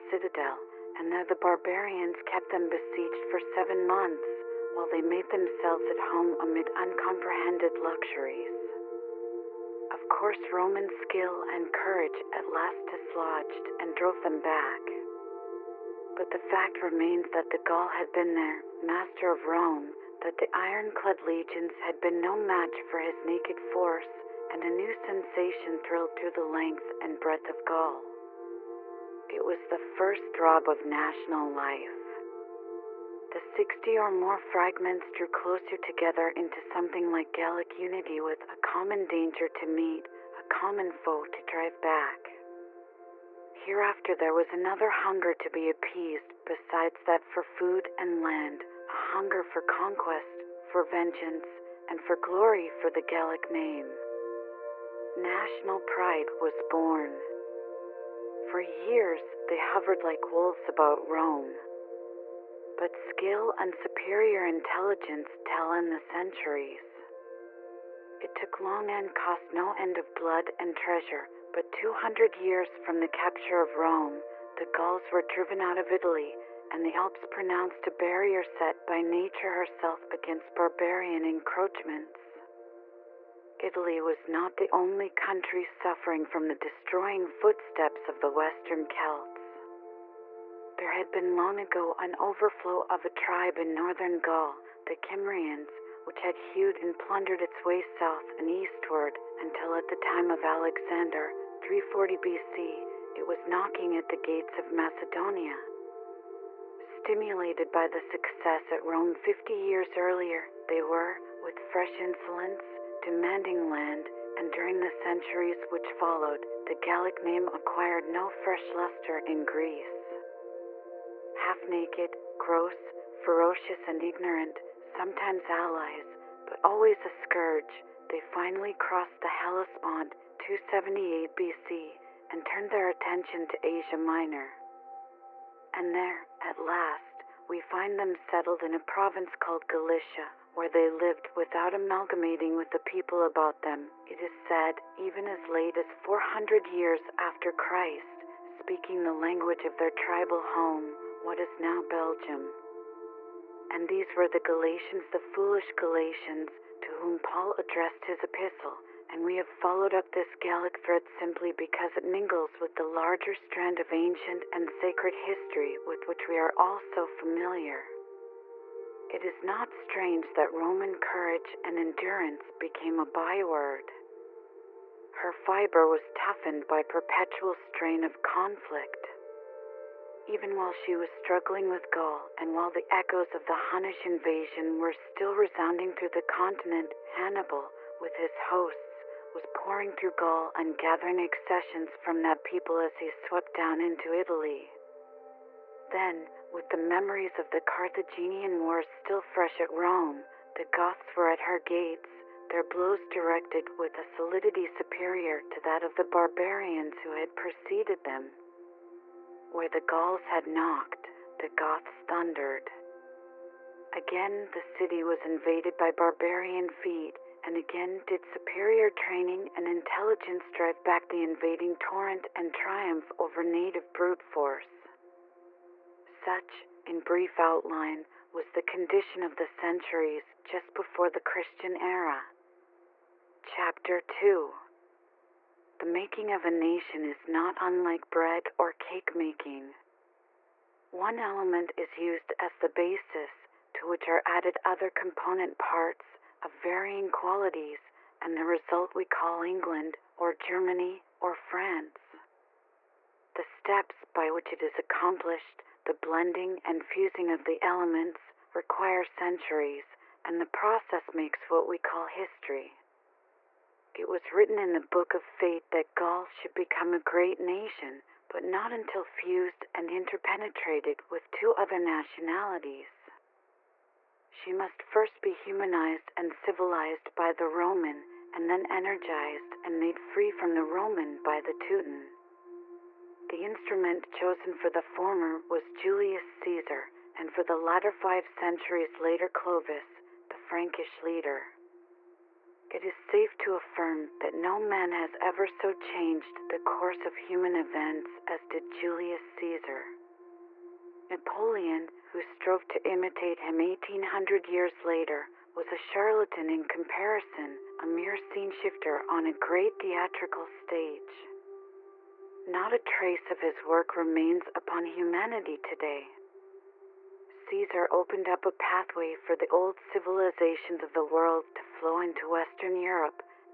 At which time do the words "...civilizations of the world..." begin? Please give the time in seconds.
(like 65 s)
319 s.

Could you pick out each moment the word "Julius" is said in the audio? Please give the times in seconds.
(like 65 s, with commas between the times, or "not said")
285 s, 298 s.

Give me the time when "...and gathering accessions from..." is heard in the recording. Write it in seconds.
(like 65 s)
190 s.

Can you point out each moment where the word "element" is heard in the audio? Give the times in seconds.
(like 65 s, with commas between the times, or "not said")
241 s, 257 s.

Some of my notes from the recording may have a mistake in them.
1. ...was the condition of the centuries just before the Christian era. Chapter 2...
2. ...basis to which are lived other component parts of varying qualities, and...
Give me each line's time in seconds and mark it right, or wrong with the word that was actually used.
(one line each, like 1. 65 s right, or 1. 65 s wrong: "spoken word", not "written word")
1. 228 s right
2. 242 s wrong: "added", not "lived".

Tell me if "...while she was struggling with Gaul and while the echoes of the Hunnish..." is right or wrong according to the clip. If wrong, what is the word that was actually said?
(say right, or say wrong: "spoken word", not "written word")
right.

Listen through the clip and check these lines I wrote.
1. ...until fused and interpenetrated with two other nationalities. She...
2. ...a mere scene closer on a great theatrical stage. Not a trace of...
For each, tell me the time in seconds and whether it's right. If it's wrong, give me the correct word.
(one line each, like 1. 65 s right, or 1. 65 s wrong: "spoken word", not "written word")
1. 268 s right
2. 307 s wrong: "shifter", not "closer".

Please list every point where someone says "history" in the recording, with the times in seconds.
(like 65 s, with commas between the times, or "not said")
165 s, 262 s.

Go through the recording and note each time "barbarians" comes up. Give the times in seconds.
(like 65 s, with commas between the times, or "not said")
1 s, 80 s, 206 s, 215 s.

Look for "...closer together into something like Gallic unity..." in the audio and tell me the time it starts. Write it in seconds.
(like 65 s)
35 s.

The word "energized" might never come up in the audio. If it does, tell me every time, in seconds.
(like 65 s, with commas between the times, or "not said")
278 s.